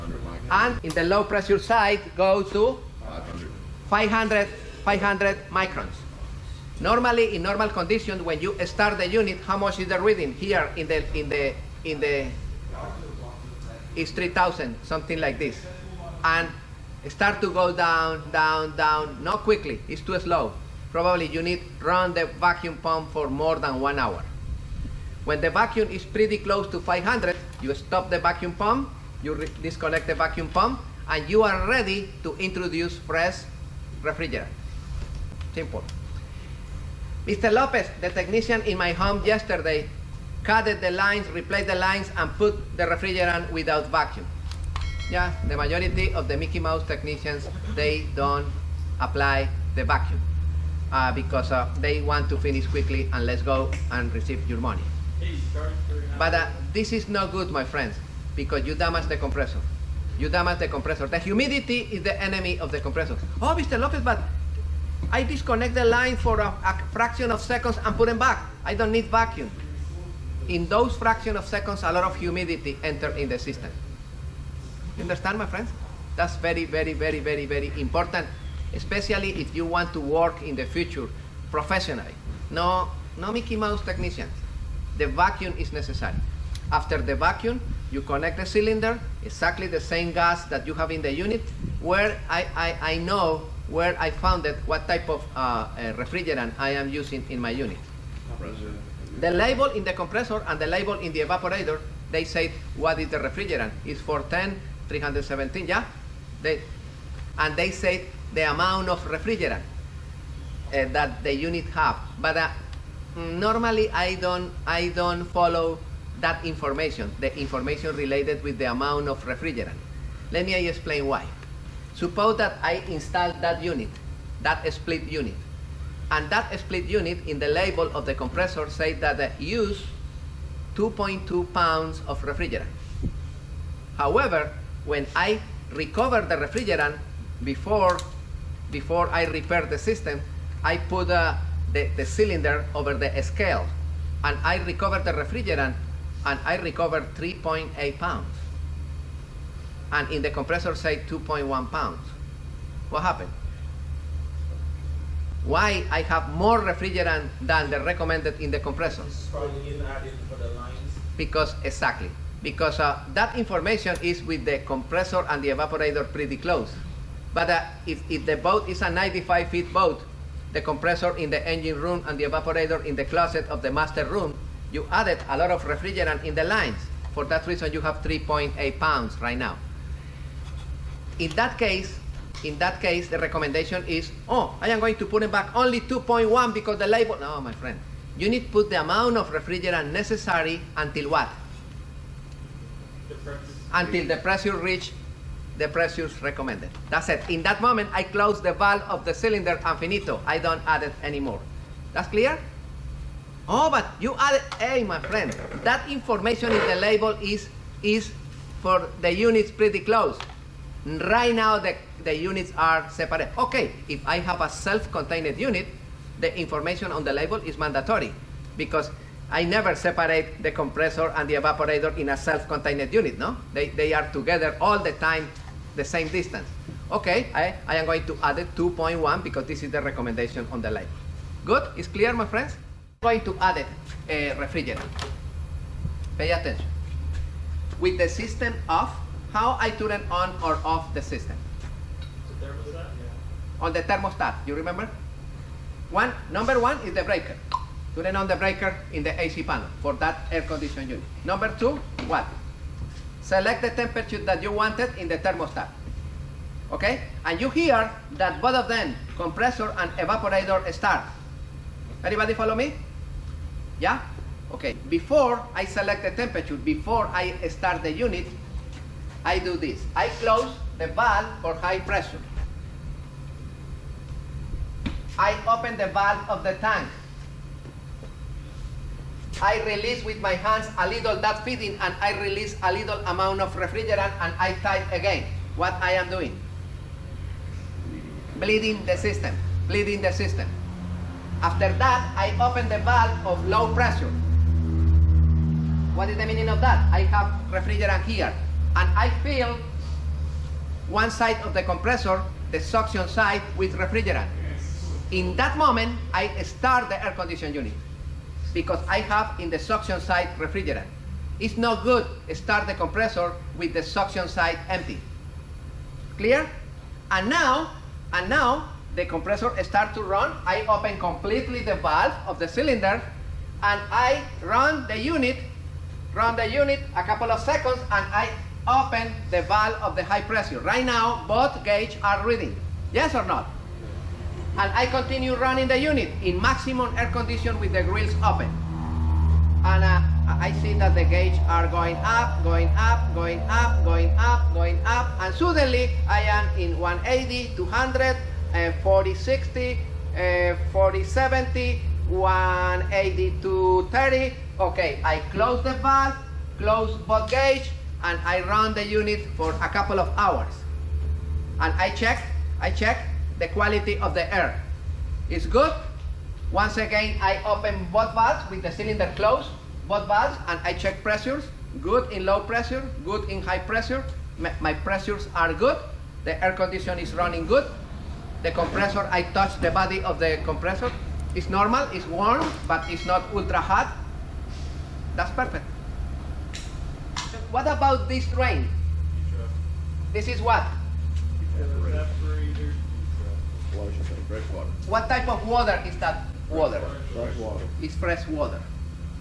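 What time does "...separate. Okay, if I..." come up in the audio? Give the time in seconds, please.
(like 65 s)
212 s.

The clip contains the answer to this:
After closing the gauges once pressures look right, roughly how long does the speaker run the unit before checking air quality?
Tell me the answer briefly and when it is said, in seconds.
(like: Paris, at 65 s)
A couple of hours, at 359 s.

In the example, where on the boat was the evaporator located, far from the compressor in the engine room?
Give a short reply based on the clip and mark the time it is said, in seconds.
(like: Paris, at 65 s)
closet of the master room, at 173 s.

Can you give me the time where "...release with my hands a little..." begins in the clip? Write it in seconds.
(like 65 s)
279 s.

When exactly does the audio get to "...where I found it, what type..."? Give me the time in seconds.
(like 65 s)
93 s.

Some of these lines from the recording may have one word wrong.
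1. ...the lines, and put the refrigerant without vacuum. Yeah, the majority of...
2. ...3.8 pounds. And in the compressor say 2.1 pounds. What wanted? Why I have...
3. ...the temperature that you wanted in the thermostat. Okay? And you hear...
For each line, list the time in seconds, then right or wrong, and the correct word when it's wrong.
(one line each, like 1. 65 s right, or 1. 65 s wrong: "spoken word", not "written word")
1. 41 s right
2. 147 s wrong: "happened", not "wanted"
3. 253 s right.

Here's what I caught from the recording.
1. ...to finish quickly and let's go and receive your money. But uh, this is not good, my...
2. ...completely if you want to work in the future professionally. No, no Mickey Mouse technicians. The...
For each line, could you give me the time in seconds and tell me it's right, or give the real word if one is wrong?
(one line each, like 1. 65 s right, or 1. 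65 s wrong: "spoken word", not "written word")
1. 52 s right
2. 78 s wrong: "especially", not "completely".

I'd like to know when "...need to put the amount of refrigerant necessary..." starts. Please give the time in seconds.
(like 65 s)
188 s.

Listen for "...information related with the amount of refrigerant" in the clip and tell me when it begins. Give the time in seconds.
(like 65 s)
117 s.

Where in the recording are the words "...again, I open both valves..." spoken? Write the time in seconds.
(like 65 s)
366 s.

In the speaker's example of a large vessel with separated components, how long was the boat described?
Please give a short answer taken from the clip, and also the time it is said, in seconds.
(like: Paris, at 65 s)
95 feet, at 168 s.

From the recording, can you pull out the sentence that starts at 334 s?
And I continue running the unit in maximum air condition with the grills open.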